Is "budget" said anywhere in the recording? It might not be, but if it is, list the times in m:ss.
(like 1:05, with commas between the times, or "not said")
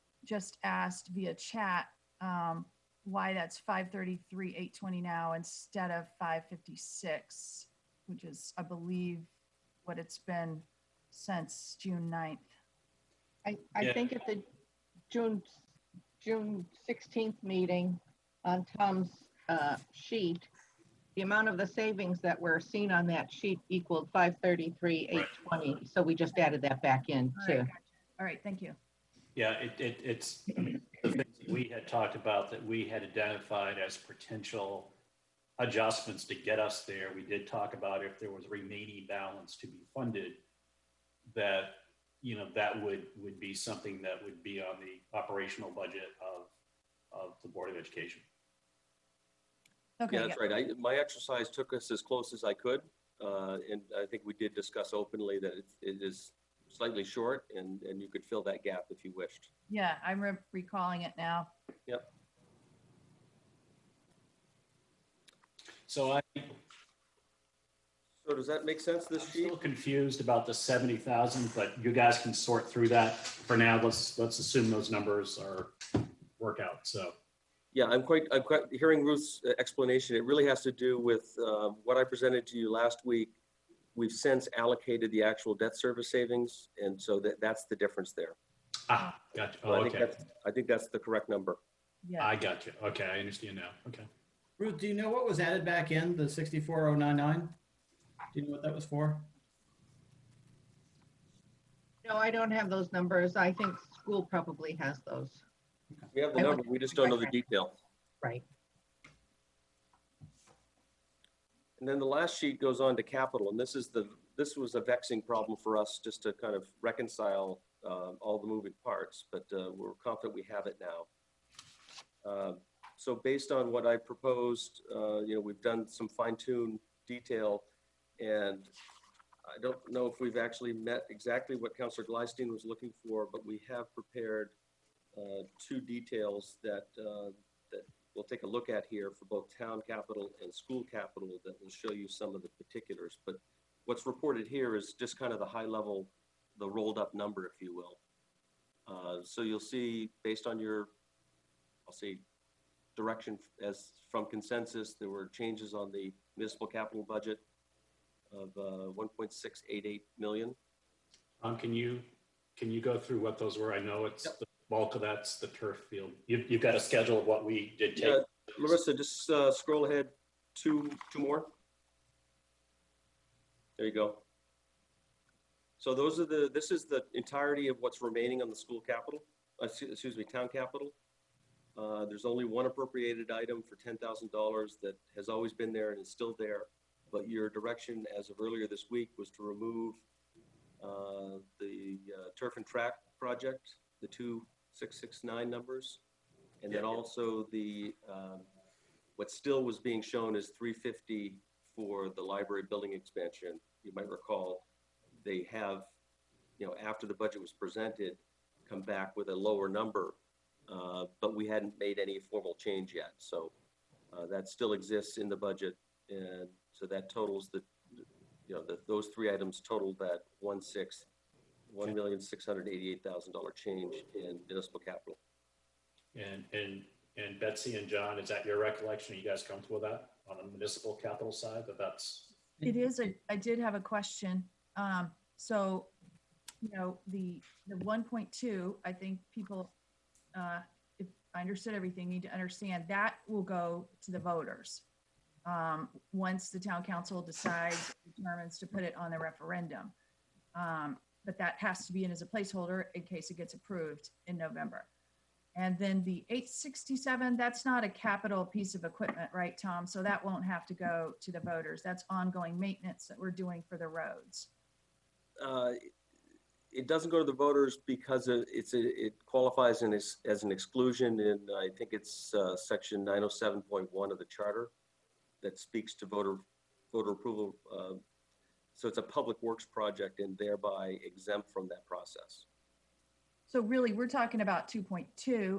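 0:45, 2:37, 3:27, 3:35.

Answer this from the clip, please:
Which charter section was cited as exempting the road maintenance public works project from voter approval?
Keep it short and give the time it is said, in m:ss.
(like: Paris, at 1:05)
907.1, at 4:33.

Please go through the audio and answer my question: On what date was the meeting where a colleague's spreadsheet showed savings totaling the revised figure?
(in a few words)
June 16th.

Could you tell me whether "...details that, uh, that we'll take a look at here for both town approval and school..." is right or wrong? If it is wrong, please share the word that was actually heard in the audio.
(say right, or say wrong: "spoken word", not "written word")
wrong: "capital", not "approval".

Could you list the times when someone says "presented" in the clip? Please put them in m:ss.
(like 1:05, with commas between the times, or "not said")
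1:22, 3:27.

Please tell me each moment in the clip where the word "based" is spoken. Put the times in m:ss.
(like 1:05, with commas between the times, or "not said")
2:03, 2:30.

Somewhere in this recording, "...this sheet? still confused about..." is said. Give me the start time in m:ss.
1:09.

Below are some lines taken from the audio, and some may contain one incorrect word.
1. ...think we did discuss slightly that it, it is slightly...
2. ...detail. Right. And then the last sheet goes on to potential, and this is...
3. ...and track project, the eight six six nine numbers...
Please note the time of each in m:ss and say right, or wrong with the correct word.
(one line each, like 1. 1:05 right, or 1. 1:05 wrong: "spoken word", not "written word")
1. 0:54 wrong: "openly", not "slightly"
2. 1:47 wrong: "capital", not "potential"
3. 3:12 wrong: "two", not "eight".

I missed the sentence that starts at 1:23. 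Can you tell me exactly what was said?
We've since allocated the actual debt service savings, and so that, that's the difference there.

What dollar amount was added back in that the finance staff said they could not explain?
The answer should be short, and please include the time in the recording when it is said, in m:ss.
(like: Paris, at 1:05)
64,099, at 1:36.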